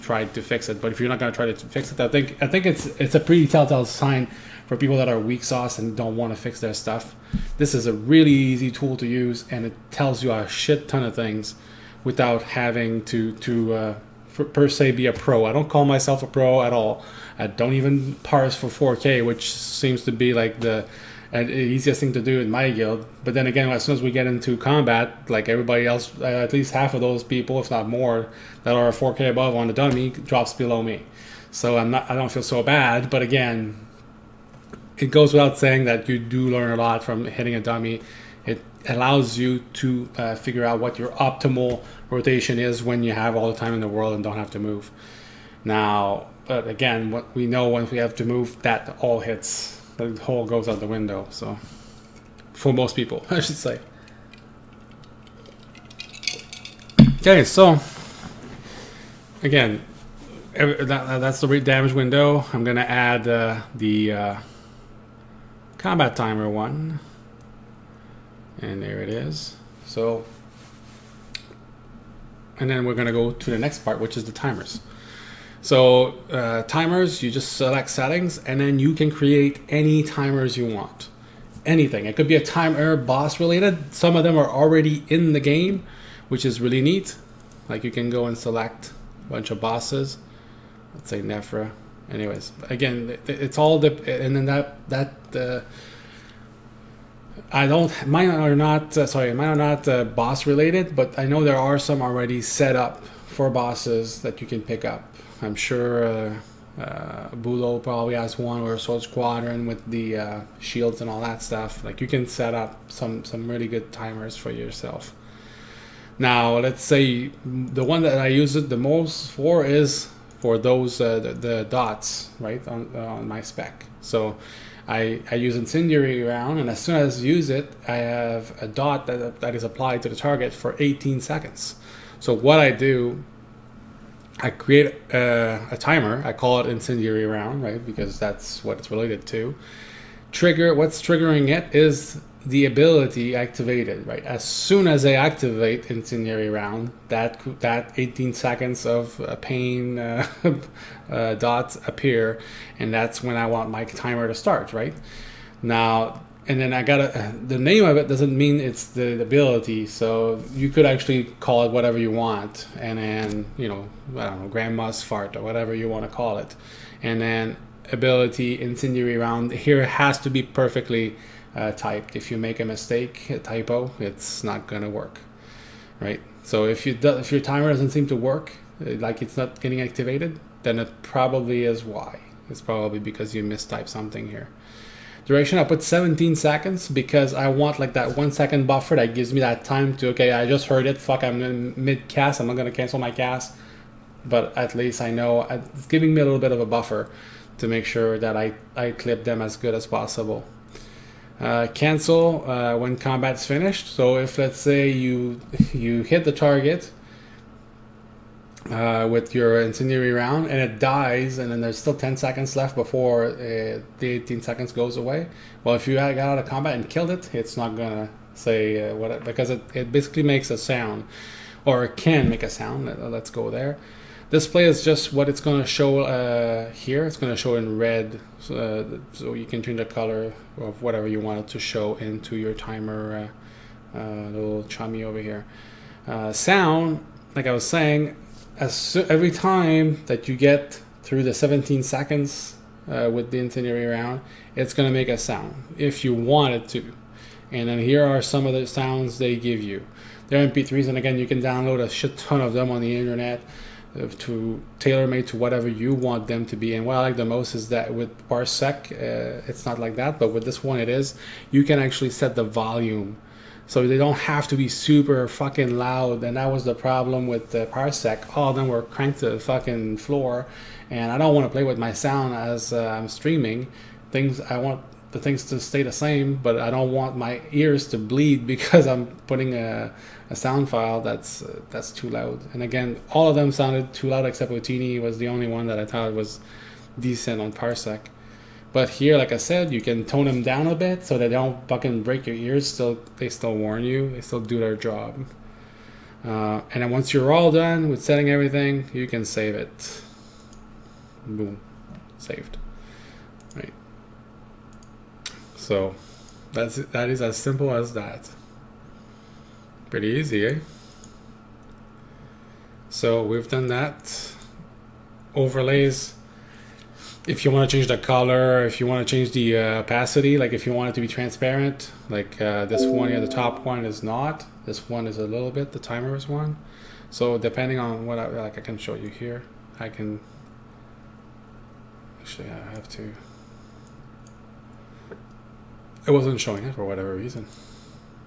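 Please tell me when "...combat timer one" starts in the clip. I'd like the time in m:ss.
1:05.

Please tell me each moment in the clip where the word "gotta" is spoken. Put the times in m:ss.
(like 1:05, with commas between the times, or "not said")
2:36.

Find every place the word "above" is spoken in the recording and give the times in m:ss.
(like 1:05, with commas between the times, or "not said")
0:29.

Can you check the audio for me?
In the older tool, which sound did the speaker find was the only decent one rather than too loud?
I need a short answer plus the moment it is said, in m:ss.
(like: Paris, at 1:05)
Otini, at 4:44.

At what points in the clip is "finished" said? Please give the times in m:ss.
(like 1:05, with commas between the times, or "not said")
3:23.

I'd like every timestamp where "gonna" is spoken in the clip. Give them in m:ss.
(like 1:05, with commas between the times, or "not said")
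1:02, 1:12, 2:54, 3:12, 3:37.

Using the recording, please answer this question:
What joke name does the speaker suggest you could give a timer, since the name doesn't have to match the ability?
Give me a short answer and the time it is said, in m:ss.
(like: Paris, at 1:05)
Grandma's Fart, at 2:44.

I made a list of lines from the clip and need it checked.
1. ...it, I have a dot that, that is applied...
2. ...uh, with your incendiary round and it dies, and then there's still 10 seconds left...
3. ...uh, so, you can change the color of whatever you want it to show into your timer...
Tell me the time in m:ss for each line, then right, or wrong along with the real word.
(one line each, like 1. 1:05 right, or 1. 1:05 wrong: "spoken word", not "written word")
1. 2:07 right
2. 3:28 right
3. 3:48 right.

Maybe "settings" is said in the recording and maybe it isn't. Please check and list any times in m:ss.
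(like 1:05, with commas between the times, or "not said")
1:17, 4:58.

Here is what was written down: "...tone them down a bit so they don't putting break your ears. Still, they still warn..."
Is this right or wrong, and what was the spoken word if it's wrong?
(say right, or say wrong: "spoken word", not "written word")
wrong: "fucking", not "putting".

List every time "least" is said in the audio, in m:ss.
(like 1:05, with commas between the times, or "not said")
0:26, 3:14.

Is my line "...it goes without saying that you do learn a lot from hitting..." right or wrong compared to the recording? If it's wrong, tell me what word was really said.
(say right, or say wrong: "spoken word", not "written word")
right.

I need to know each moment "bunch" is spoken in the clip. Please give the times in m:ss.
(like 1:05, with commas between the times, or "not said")
1:29.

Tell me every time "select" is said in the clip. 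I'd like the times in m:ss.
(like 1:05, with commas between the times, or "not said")
1:17, 1:28.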